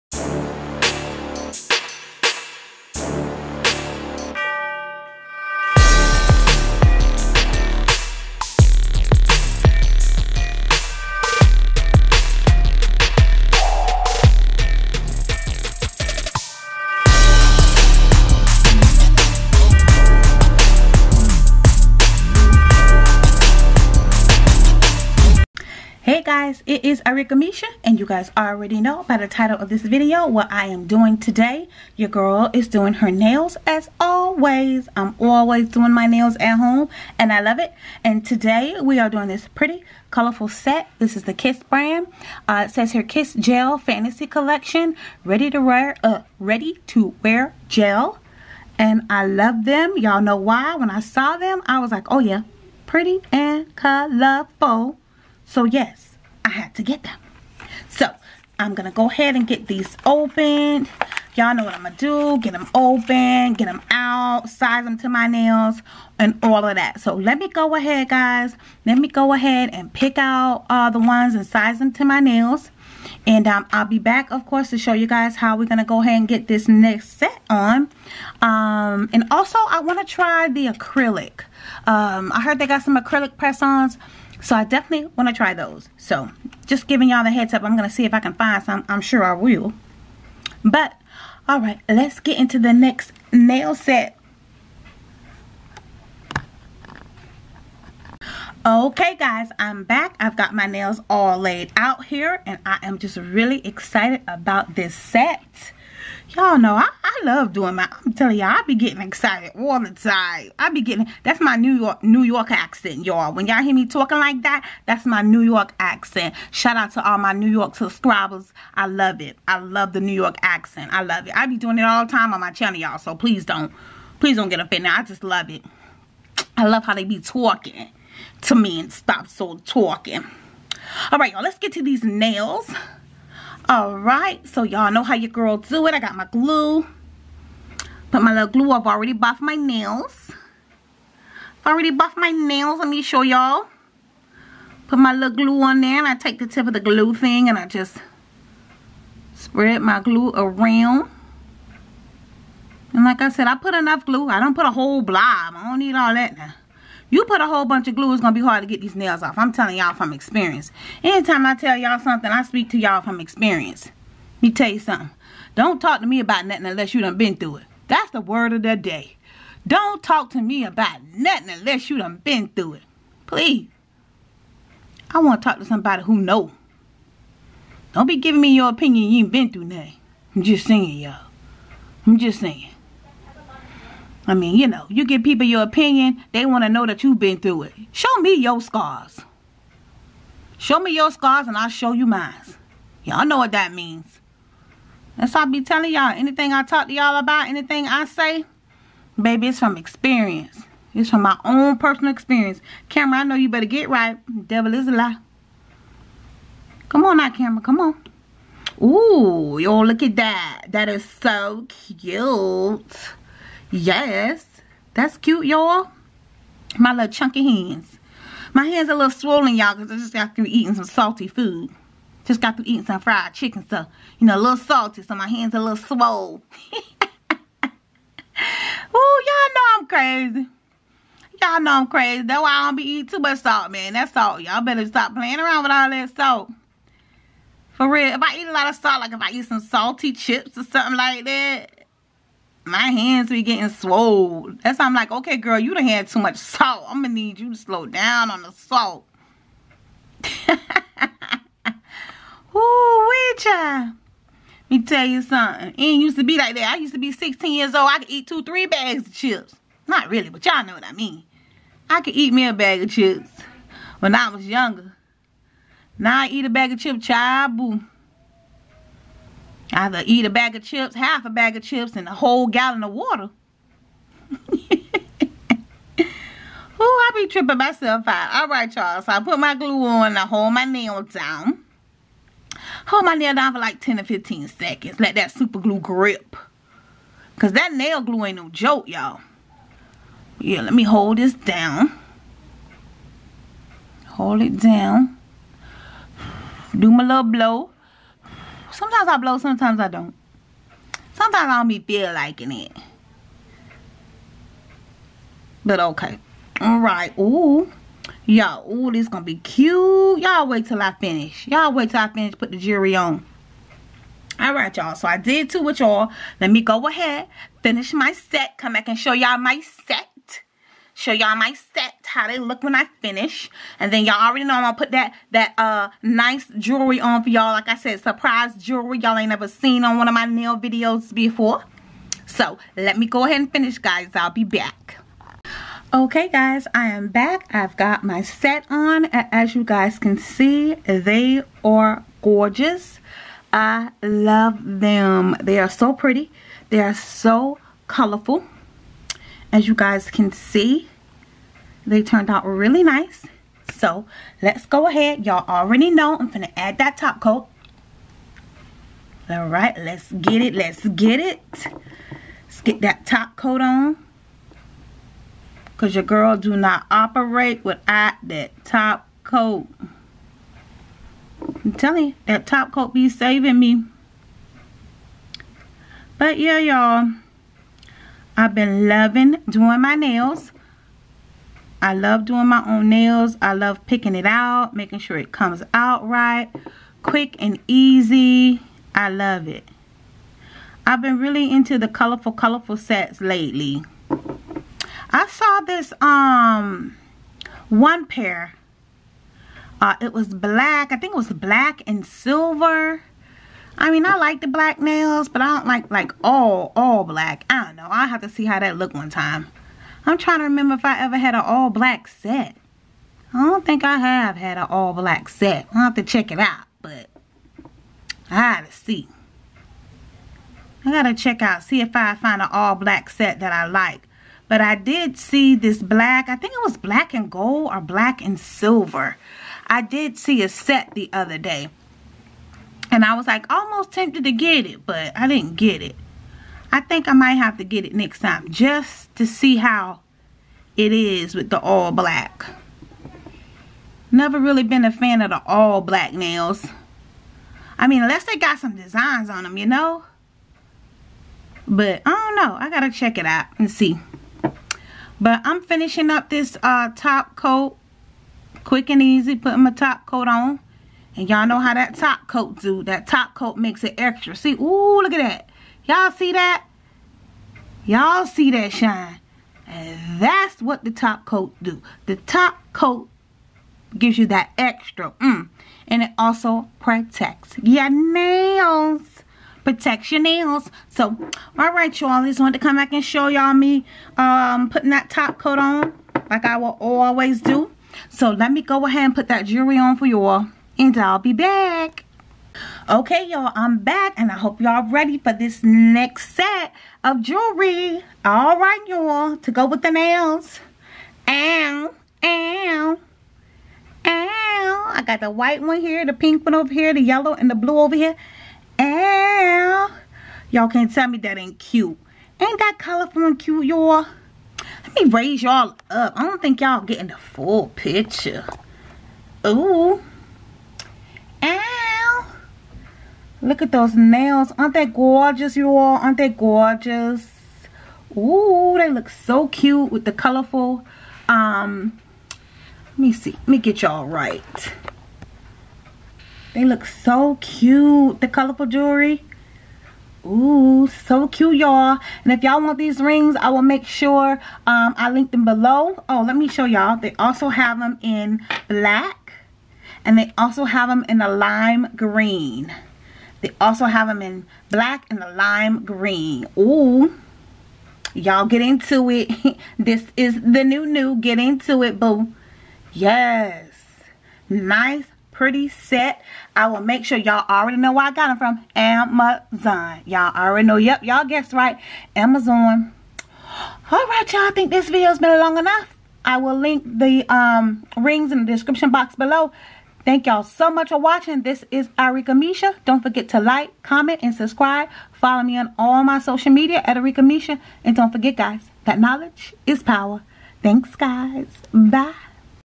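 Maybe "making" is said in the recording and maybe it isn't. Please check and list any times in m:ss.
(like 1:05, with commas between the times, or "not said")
6:24.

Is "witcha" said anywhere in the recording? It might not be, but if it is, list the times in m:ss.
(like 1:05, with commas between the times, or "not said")
4:13.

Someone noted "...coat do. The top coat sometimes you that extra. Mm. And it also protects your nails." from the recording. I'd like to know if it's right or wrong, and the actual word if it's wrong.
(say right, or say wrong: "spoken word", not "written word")
wrong: "gives", not "sometimes".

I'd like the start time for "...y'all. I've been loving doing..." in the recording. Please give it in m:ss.
6:16.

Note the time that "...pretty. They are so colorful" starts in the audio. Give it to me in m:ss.
5:45.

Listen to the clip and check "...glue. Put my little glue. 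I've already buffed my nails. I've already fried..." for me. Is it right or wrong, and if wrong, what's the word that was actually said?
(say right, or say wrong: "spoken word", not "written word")
wrong: "buffed", not "fried".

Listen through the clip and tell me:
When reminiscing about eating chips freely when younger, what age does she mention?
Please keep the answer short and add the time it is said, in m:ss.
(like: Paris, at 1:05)
16, at 4:17.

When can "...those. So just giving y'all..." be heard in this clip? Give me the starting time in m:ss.
1:25.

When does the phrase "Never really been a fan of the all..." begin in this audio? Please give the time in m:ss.
7:24.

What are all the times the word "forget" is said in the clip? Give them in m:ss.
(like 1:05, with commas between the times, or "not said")
9:43, 9:48.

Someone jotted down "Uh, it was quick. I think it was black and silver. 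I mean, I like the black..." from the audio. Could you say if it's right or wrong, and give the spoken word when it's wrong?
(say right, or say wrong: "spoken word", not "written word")
wrong: "black", not "quick".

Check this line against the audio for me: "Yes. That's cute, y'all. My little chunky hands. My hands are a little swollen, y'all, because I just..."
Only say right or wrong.
right.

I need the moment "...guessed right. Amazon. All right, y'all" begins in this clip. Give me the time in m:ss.
9:31.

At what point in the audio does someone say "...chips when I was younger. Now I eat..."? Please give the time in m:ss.
4:22.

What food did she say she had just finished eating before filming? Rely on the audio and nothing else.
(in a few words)
fried chicken.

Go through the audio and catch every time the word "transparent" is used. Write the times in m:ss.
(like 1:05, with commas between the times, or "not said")
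not said.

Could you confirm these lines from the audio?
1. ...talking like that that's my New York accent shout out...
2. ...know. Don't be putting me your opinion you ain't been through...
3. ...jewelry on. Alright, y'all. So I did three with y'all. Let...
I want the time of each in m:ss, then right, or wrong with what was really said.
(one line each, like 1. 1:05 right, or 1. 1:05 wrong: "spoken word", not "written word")
1. 1:53 right
2. 2:56 wrong: "giving", not "putting"
3. 5:12 wrong: "two", not "three".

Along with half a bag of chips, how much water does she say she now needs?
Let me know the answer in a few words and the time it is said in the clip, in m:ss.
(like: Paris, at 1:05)
a whole gallon, at 4:32.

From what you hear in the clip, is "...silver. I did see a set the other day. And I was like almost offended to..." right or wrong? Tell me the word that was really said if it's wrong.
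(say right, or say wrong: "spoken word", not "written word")
wrong: "tempted", not "offended".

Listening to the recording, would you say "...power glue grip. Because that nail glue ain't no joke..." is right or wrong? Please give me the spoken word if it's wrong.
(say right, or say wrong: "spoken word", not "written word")
wrong: "super", not "power".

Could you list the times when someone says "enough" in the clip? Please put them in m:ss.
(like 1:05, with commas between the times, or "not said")
2:33, 9:35.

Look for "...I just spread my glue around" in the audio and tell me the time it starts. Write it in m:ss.
2:27.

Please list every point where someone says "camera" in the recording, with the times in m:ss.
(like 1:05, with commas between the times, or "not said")
3:22, 3:27.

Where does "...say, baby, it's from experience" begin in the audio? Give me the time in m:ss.
3:18.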